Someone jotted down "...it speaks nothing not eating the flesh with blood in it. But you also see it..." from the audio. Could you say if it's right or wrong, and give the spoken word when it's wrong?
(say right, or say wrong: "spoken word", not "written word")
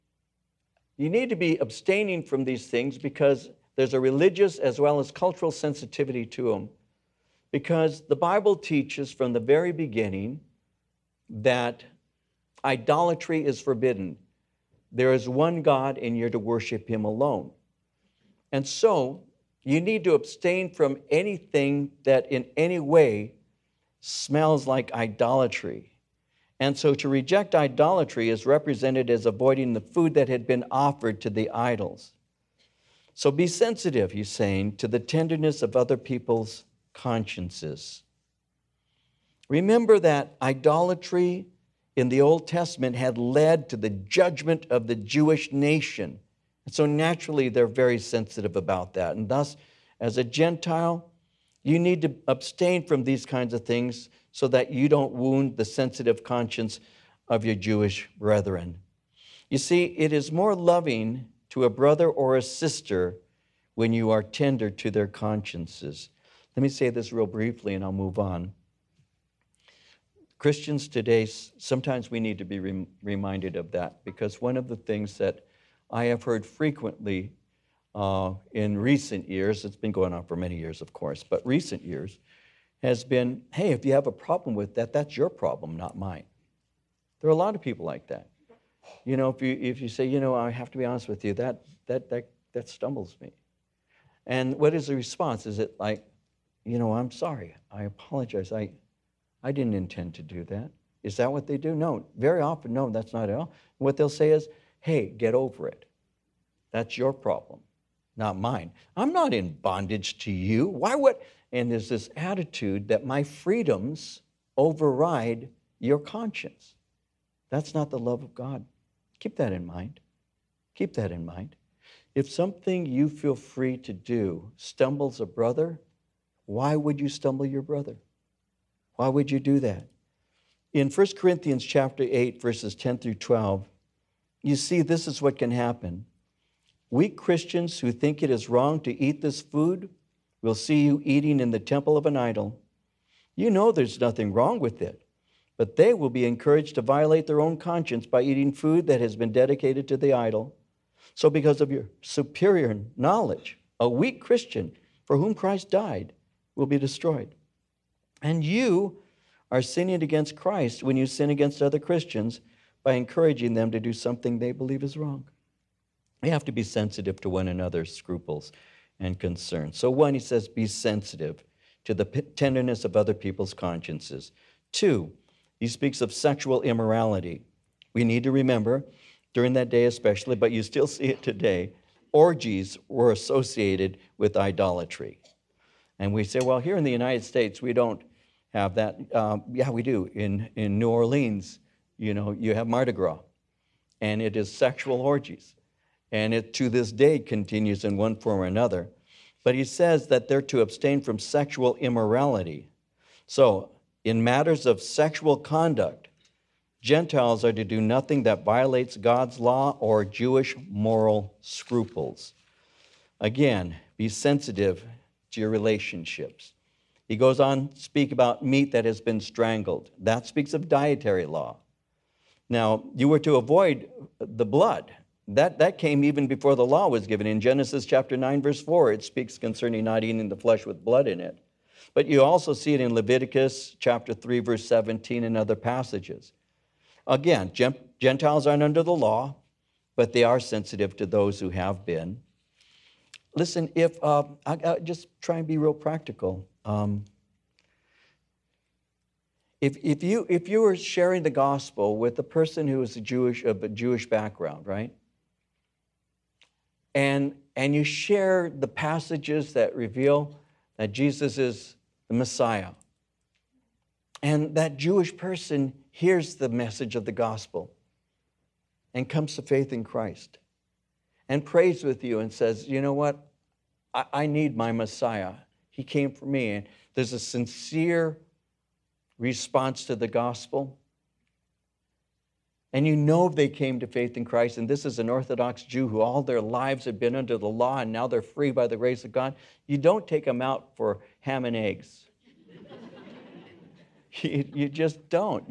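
wrong: "concerning", not "nothing".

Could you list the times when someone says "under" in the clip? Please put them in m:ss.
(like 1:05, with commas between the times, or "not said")
3:58, 4:47.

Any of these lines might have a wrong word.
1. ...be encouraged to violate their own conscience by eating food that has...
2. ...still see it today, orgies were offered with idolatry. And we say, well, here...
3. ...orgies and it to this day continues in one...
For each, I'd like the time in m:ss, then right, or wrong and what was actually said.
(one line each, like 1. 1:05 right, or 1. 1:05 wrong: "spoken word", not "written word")
1. 2:26 right
2. 3:00 wrong: "associated", not "offered"
3. 3:15 right.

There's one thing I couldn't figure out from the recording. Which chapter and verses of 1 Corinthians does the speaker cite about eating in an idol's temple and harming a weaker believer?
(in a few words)
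chapter 8 verses 10-12.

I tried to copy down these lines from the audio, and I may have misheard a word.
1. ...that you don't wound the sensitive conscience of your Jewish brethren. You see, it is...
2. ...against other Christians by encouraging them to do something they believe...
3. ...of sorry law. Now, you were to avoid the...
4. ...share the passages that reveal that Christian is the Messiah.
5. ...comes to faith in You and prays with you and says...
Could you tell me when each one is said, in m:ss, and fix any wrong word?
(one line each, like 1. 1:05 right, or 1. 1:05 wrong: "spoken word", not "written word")
1. 0:54 right
2. 2:41 right
3. 3:40 wrong: "dietary", not "sorry"
4. 4:17 wrong: "Jesus", not "Christian"
5. 4:29 wrong: "Christ", not "You".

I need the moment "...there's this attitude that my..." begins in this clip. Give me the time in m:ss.
1:51.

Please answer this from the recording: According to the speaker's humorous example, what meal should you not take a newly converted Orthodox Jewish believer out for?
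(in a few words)
ham and eggs.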